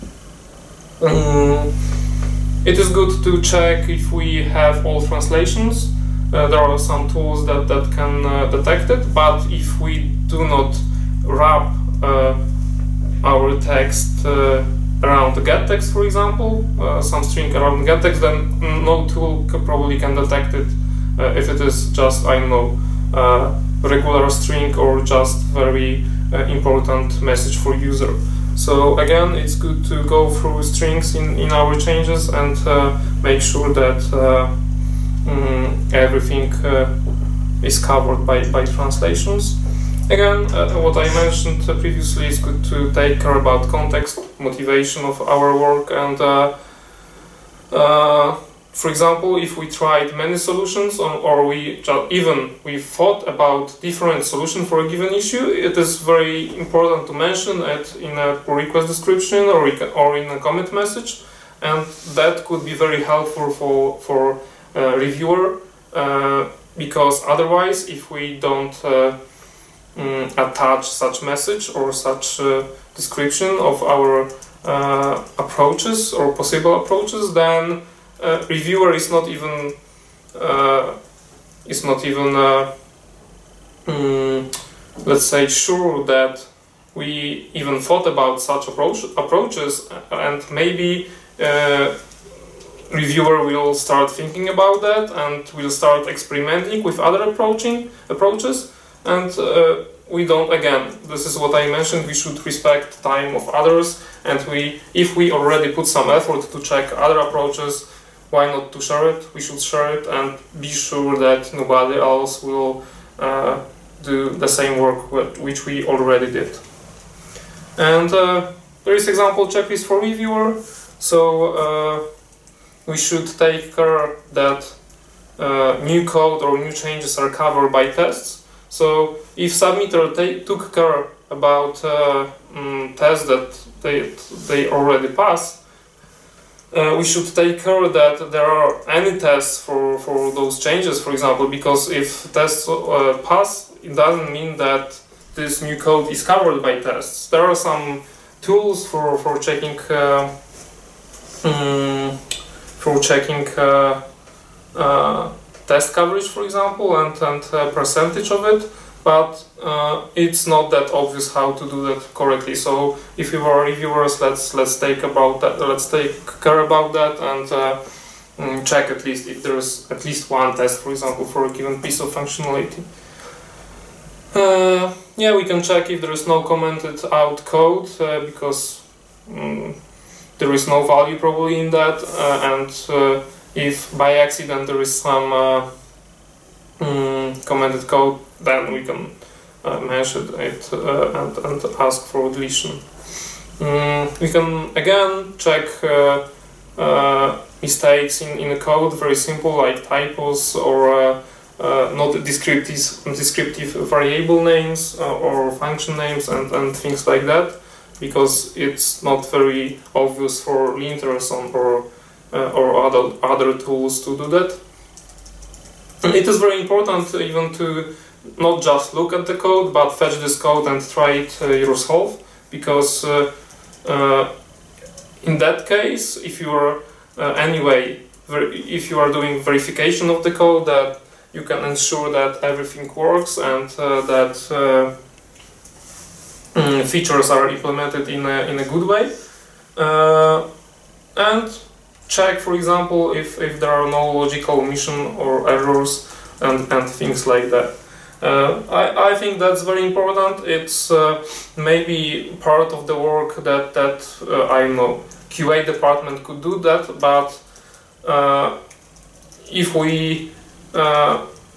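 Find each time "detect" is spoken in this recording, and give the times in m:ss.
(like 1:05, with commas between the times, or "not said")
0:08, 0:20.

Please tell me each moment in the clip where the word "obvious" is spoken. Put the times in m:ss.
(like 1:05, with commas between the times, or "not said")
2:40, 3:29.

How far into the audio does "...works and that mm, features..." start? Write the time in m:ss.
3:52.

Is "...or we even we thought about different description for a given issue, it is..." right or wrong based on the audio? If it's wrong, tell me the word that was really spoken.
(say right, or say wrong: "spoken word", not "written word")
wrong: "solution", not "description".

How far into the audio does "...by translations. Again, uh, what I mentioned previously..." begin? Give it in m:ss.
0:38.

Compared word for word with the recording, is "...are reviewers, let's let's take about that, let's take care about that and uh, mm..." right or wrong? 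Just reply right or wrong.
right.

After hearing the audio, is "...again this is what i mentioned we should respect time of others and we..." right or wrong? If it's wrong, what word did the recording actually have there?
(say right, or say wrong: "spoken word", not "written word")
right.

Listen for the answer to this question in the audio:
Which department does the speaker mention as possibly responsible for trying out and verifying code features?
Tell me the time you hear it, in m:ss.
4:15.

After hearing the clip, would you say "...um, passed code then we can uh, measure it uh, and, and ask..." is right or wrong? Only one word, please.
wrong.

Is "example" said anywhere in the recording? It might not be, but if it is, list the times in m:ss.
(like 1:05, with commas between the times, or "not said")
0:16, 0:48, 1:59, 2:21, 2:36, 2:50, 4:02.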